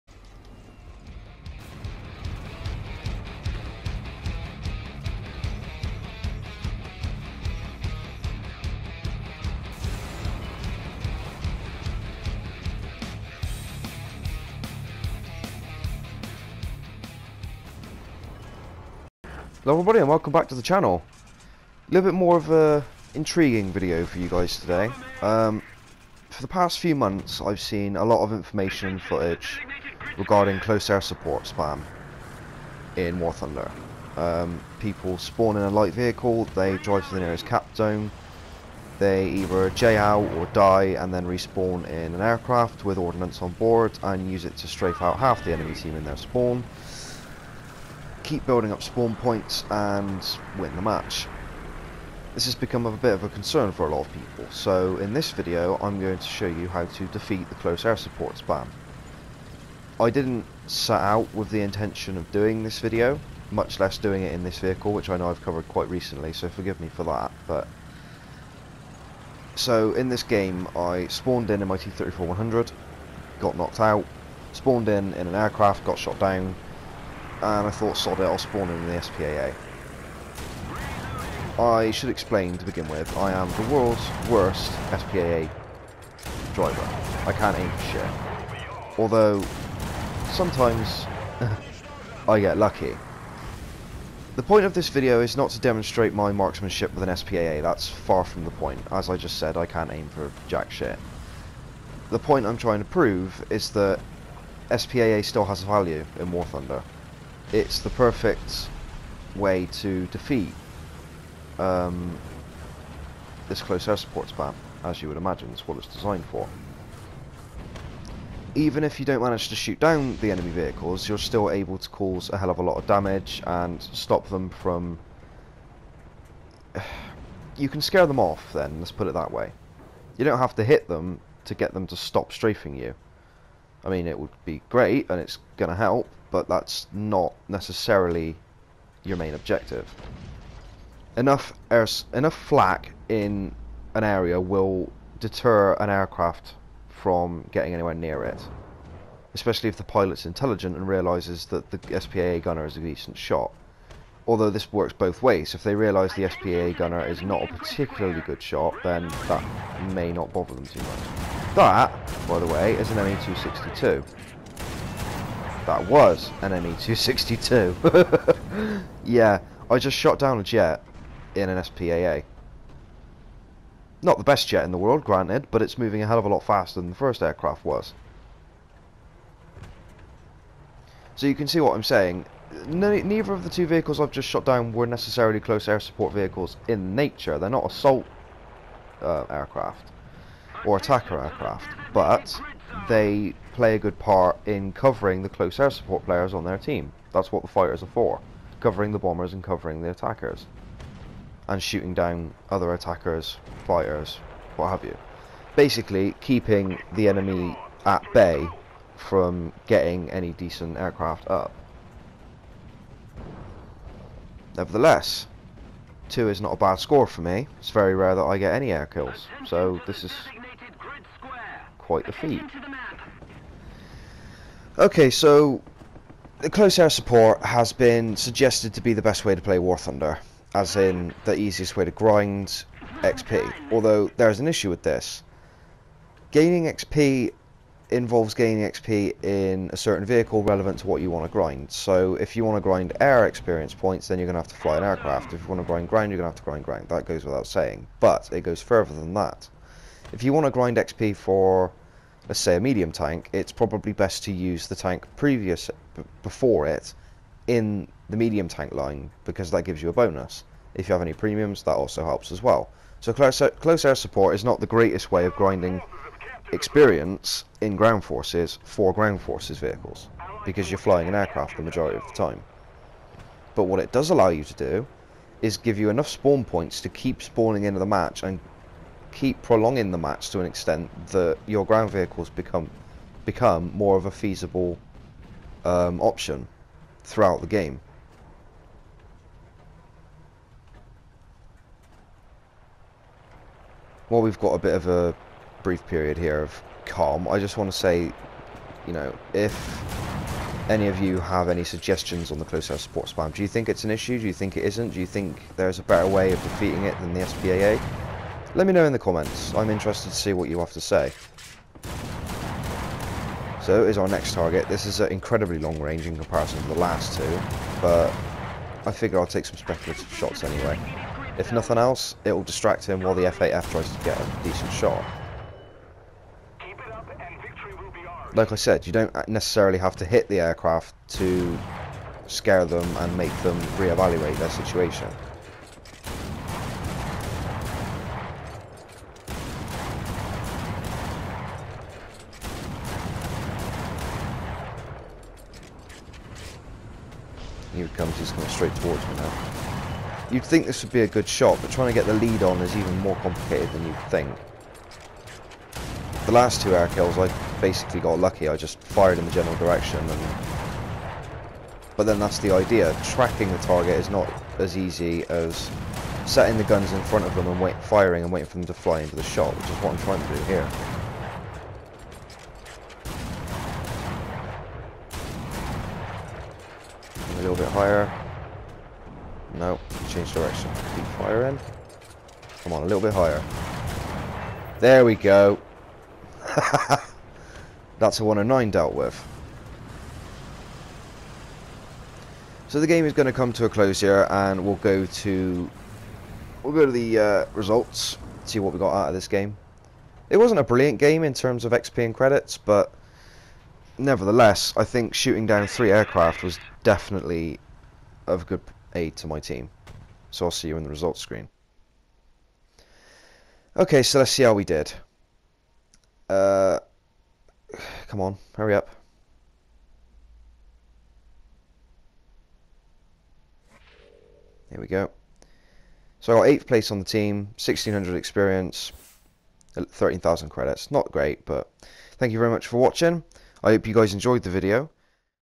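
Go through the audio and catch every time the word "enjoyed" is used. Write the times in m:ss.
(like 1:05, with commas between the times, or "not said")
7:14.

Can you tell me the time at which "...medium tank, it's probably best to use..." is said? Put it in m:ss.
4:12.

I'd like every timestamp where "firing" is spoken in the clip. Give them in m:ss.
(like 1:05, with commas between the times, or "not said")
6:07, 6:21.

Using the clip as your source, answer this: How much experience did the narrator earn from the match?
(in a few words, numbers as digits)
1600.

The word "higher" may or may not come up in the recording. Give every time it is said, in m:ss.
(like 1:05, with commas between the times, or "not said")
6:17, 6:23.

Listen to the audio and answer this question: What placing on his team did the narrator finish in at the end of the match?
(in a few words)
8th place.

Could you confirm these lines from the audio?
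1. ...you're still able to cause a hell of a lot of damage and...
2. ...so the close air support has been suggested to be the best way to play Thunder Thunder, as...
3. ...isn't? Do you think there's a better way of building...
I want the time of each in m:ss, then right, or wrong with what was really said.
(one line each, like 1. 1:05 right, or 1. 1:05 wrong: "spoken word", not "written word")
1. 2:01 right
2. 3:45 wrong: "War", not "Thunder"
3. 5:04 wrong: "defeating", not "building".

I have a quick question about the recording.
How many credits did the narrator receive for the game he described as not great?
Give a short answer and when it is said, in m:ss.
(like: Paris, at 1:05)
13,000, at 7:09.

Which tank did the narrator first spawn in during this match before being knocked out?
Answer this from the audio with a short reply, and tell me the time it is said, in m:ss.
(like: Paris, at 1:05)
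T-34-100, at 1:11.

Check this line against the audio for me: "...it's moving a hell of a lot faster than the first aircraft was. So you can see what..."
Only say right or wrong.
right.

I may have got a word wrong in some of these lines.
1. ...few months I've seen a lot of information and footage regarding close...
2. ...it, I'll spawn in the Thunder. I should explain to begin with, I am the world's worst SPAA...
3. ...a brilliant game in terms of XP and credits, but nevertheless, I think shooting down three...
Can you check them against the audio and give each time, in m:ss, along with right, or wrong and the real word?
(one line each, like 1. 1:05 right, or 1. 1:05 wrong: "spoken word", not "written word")
1. 0:26 right
2. 1:18 wrong: "SPAA", not "Thunder"
3. 6:40 right.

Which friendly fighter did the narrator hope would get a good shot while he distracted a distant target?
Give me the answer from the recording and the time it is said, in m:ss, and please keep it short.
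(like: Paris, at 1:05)
F8F, at 5:23.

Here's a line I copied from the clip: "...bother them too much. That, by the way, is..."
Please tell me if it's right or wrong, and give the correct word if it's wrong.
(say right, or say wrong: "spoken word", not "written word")
right.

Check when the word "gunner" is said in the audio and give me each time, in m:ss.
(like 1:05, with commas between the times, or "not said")
2:32, 2:36.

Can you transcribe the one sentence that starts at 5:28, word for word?
Like I said, you don't necessarily have to hit the aircraft to scare them and make them re-evaluate their situation.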